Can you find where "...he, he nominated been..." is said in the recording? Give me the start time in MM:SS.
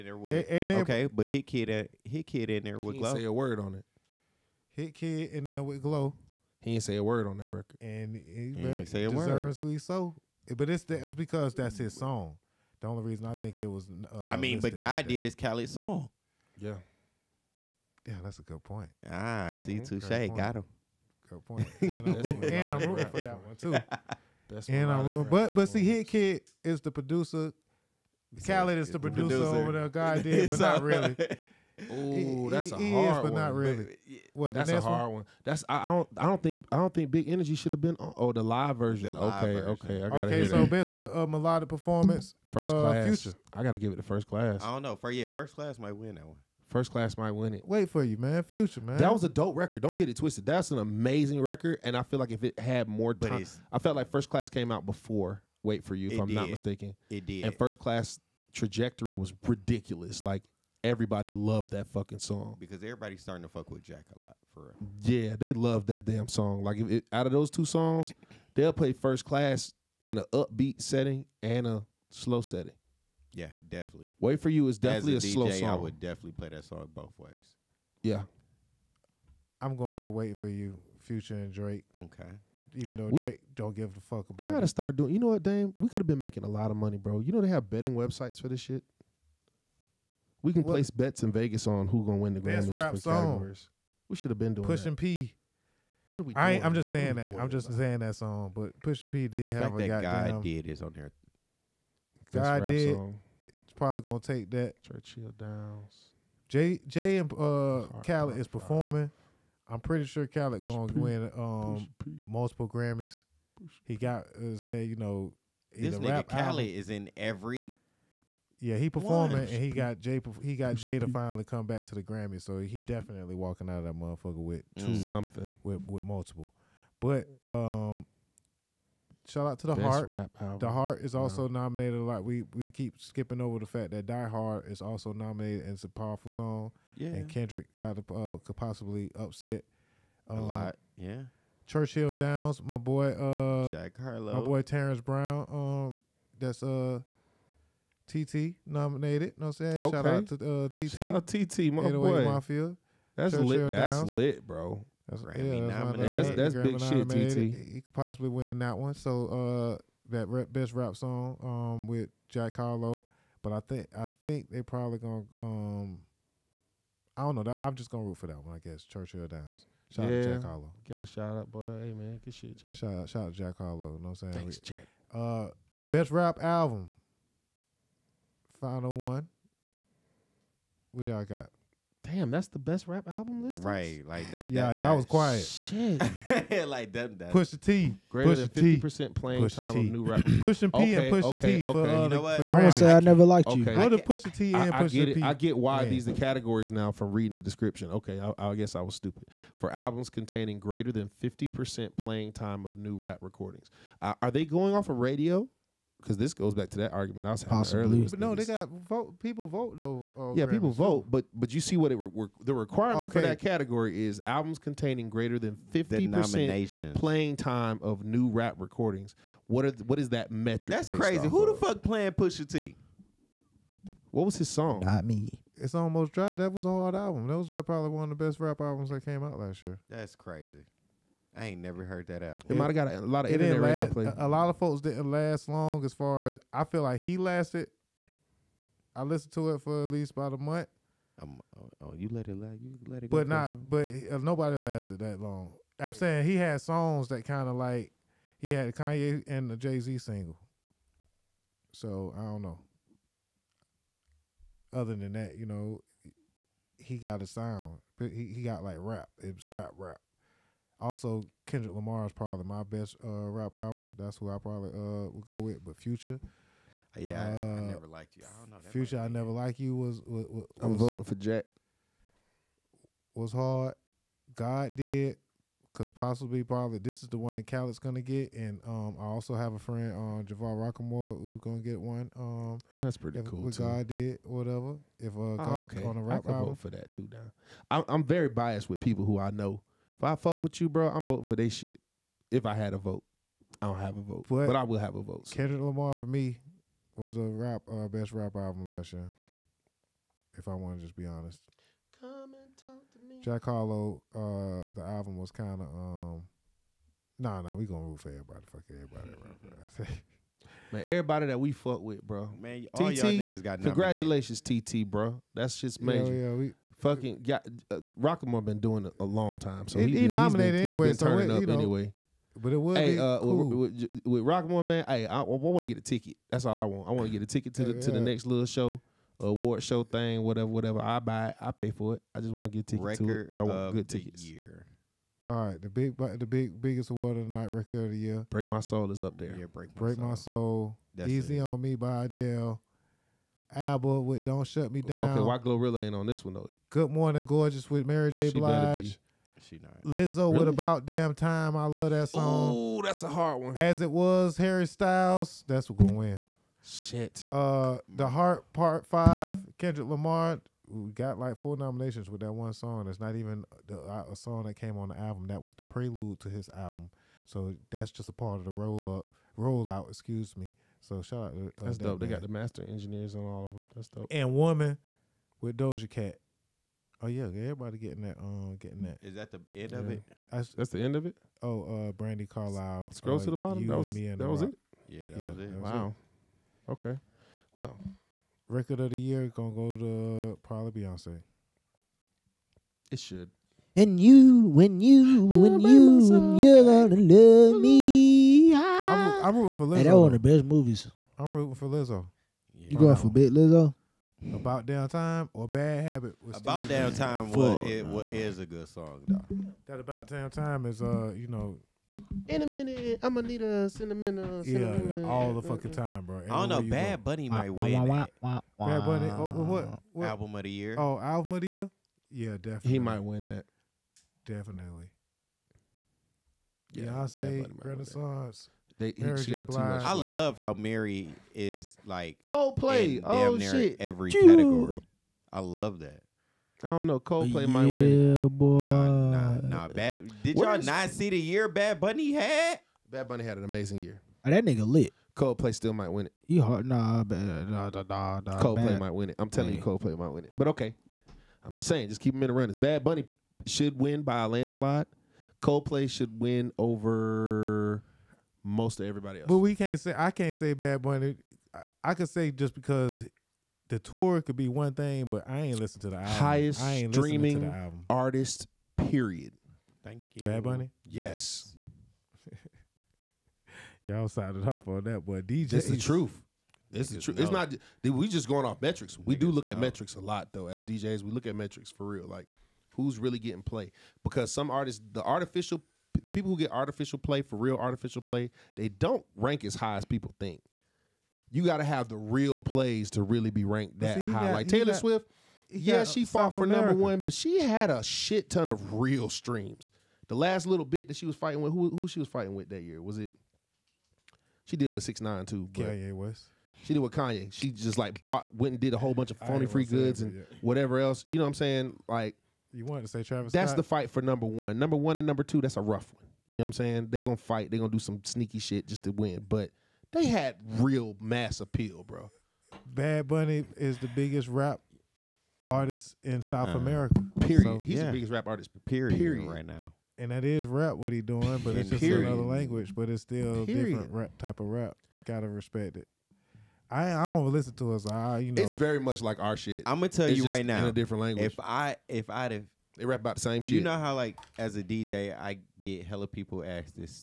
05:19.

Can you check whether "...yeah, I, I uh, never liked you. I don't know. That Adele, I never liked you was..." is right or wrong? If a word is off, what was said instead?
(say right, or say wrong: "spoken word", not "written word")
wrong: "Future", not "Adele".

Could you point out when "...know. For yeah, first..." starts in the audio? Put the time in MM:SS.
00:44.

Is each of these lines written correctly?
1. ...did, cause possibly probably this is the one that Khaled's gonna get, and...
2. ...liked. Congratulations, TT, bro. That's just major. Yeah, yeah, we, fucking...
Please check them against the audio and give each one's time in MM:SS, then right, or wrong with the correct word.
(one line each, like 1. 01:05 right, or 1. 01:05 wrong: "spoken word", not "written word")
1. 04:34 right
2. 05:13 wrong: "nominated", not "liked".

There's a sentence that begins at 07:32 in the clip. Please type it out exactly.
Bad Bunny should win by a landslide.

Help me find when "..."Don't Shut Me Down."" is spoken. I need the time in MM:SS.
05:44.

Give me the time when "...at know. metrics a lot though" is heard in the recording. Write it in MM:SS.
07:59.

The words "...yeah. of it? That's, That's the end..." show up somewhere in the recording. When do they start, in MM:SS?
06:19.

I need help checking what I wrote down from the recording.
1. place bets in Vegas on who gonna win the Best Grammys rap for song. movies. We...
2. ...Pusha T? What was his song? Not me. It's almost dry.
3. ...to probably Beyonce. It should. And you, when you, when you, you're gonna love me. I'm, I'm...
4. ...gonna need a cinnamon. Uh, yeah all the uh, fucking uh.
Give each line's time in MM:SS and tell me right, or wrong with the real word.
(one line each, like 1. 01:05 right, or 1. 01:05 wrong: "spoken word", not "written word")
1. 01:30 wrong: "categories", not "movies"
2. 03:42 right
3. 06:29 right
4. 06:53 right.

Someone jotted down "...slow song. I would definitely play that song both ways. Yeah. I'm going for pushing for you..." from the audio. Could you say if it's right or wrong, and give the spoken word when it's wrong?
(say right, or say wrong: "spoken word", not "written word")
wrong: "waiting", not "pushing".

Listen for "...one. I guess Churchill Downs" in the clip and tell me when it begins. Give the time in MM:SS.
02:48.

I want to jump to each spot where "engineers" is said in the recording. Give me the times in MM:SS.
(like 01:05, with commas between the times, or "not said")
06:12.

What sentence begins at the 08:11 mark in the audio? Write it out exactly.
You got to have the real plays to really be ranked that see, high.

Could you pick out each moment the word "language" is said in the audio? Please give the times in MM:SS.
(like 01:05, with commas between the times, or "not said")
08:52, 09:01.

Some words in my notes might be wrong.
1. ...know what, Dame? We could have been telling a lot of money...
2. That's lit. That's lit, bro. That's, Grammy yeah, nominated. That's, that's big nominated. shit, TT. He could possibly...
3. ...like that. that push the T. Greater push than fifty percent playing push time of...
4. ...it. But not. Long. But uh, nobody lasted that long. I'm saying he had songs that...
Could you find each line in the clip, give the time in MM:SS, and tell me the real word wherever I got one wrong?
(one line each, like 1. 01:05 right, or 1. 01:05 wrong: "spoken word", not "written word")
1. 01:25 wrong: "making", not "telling"
2. 02:33 right
3. 03:06 right
4. 04:03 right.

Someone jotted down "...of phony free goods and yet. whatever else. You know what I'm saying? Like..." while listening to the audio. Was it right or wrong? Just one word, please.
right.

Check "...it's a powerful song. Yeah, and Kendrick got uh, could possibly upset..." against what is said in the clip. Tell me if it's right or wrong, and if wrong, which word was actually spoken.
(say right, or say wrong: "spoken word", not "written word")
right.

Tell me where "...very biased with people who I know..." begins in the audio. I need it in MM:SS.
04:48.